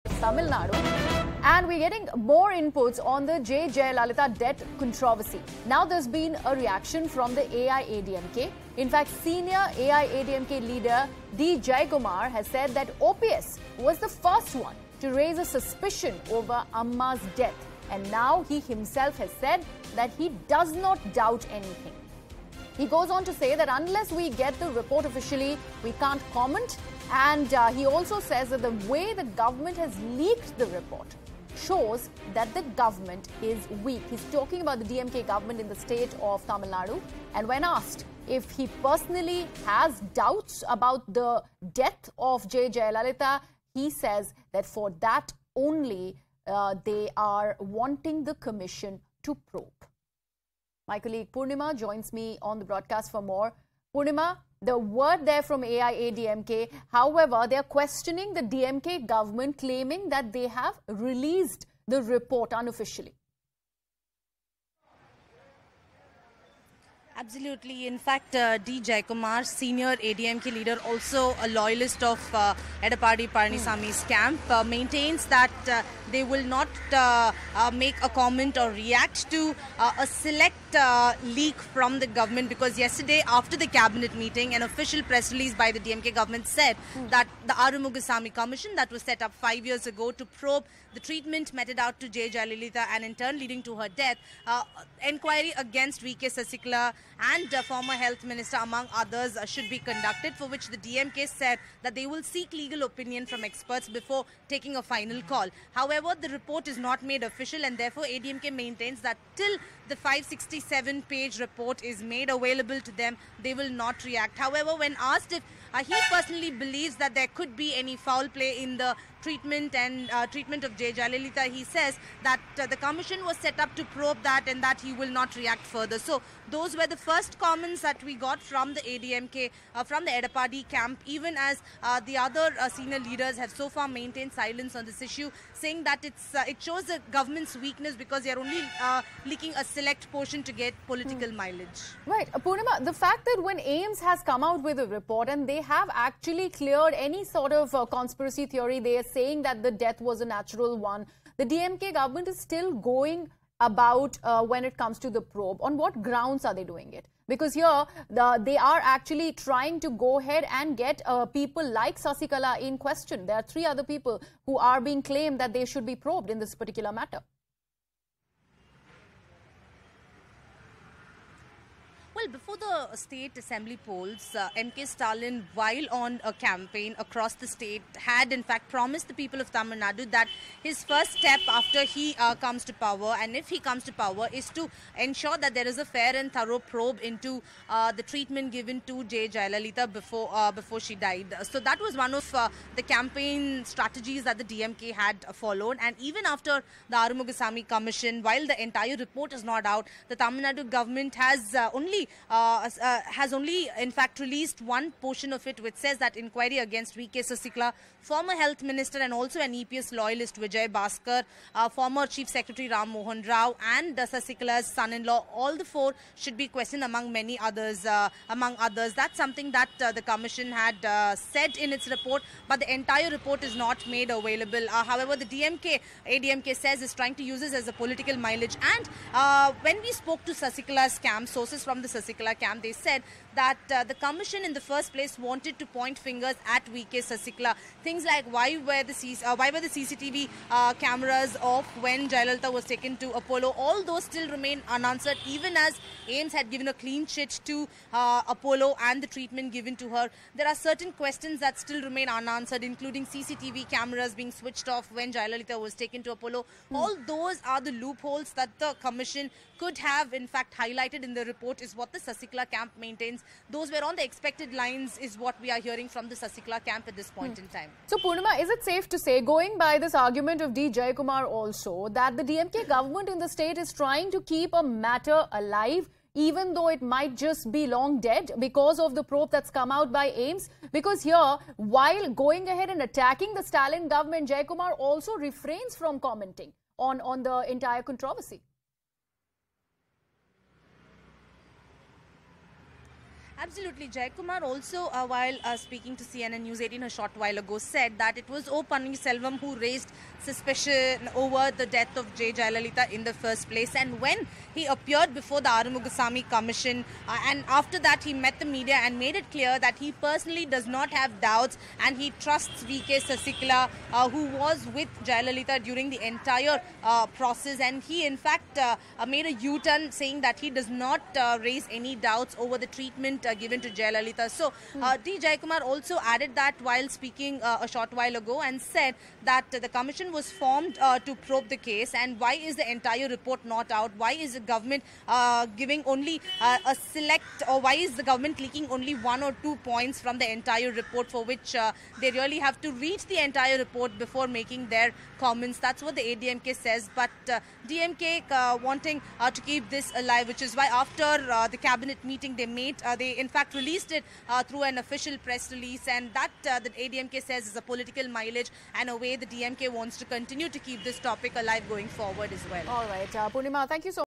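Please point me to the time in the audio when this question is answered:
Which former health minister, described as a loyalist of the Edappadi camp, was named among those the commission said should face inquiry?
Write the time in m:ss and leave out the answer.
3:30.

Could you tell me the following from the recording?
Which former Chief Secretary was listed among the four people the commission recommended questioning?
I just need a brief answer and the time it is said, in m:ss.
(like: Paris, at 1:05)
Ram Mohan Rao, at 3:32.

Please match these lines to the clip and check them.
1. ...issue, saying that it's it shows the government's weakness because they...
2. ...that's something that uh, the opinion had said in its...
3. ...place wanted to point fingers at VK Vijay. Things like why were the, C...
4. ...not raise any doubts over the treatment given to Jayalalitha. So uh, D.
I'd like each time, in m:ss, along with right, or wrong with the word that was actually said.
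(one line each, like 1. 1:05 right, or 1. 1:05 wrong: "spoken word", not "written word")
1. 2:15 right
2. 3:38 wrong: "commission", not "opinion"
3. 3:54 wrong: "Sasikala", not "Vijay"
4. 5:20 right.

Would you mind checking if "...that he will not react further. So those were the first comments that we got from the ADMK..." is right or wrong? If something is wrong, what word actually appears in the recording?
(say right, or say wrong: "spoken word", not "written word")
right.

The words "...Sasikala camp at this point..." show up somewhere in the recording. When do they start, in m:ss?
4:26.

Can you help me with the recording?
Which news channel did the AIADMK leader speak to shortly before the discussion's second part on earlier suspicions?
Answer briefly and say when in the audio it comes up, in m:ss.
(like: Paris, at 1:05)
CNN News 18, at 4:56.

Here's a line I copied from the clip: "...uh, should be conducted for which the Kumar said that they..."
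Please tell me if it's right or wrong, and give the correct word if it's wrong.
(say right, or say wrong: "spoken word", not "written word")
wrong: "DMK", not "Kumar".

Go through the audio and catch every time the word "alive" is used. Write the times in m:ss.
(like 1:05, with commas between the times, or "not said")
4:35, 5:49, 6:01.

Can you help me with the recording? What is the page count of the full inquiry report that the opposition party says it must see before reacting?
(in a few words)
567.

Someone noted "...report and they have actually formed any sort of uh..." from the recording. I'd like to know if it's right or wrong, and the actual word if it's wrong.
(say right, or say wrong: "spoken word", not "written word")
wrong: "cleared", not "formed".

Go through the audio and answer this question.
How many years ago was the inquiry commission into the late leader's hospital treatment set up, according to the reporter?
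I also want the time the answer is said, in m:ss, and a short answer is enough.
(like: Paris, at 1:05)
5, at 1:29.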